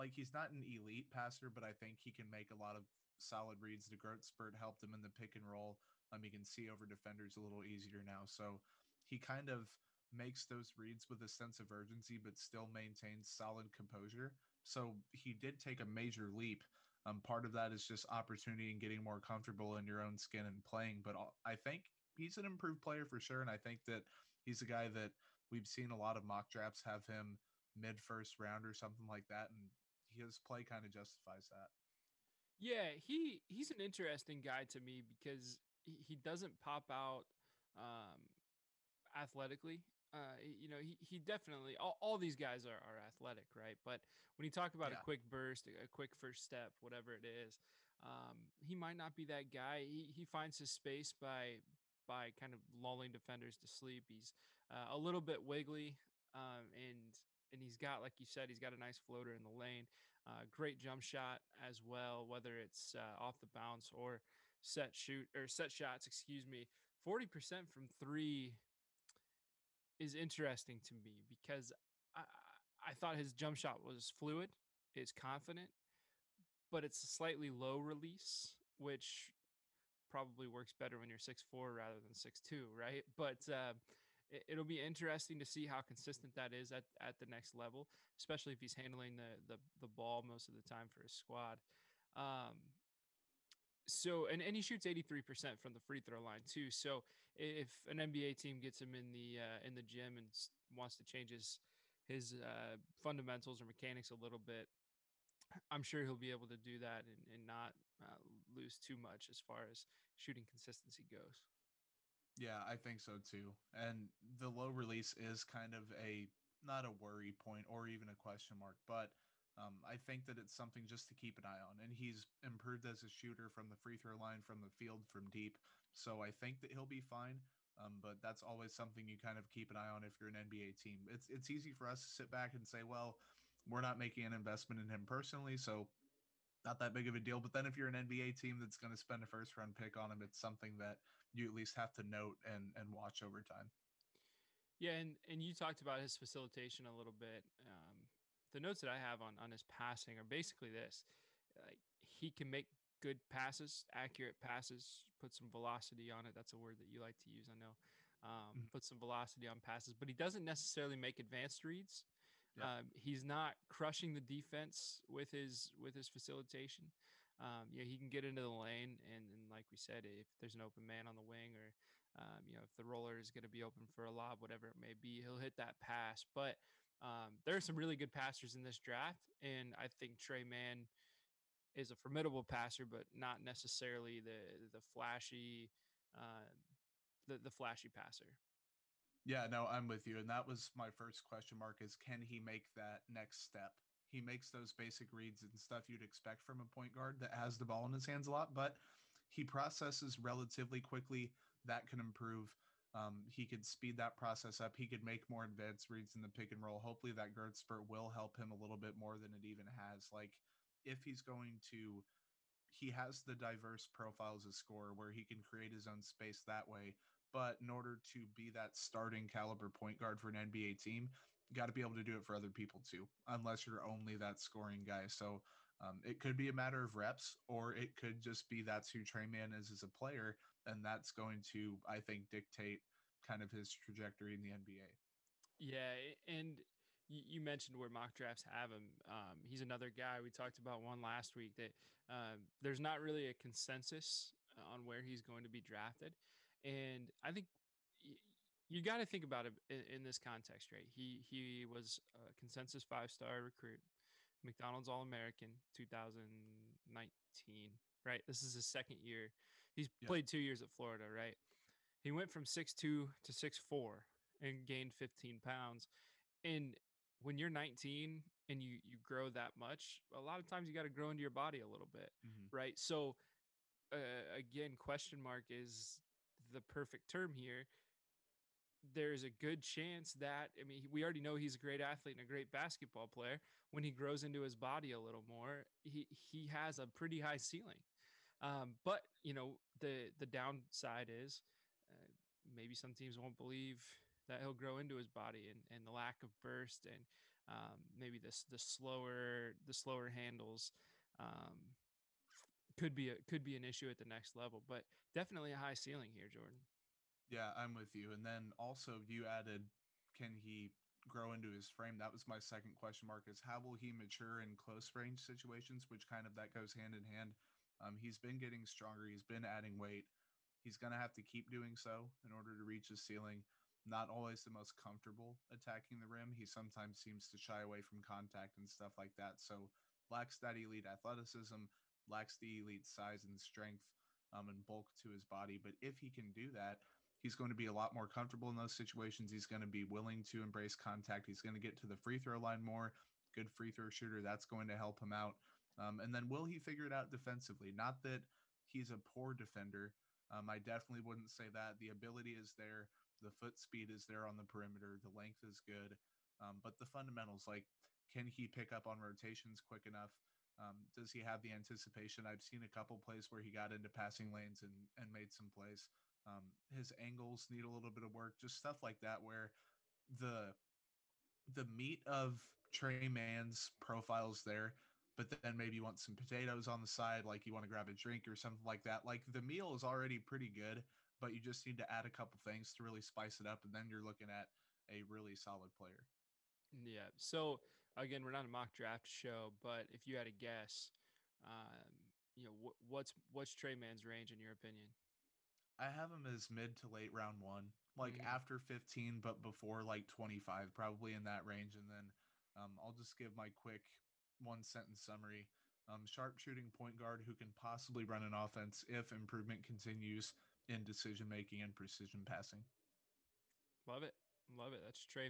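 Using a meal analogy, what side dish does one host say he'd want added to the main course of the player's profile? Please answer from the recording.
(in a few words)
potatoes.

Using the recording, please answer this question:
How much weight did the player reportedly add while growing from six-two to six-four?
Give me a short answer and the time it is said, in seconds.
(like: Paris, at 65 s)
15 pounds, at 264 s.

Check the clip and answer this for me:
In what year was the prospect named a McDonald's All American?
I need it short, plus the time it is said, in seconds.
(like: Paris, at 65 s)
2019, at 255 s.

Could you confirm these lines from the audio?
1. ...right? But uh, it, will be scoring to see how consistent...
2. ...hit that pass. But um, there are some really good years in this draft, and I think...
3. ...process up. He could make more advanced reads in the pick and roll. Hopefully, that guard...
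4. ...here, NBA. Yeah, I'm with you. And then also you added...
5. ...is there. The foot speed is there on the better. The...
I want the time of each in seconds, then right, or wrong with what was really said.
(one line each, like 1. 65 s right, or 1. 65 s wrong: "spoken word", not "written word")
1. 82 s wrong: "interesting", not "scoring"
2. 175 s wrong: "passers", not "years"
3. 204 s right
4. 306 s wrong: "Jordan", not "NBA"
5. 352 s wrong: "perimeter", not "better".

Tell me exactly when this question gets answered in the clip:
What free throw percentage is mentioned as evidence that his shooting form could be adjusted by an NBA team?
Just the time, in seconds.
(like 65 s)
94 s.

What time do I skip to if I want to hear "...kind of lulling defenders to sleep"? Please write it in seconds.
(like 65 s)
52 s.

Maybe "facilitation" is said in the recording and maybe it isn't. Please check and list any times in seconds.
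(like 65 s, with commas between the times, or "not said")
146 s, 166 s.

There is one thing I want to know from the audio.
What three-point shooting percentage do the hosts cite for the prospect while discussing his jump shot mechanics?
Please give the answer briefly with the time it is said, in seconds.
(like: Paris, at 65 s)
40%, at 67 s.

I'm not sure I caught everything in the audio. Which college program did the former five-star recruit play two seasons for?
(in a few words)
Florida.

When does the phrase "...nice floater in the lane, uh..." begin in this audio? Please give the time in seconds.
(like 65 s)
58 s.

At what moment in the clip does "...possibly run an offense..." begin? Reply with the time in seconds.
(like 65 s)
407 s.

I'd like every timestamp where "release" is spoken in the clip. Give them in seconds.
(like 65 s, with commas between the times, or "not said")
77 s, 114 s.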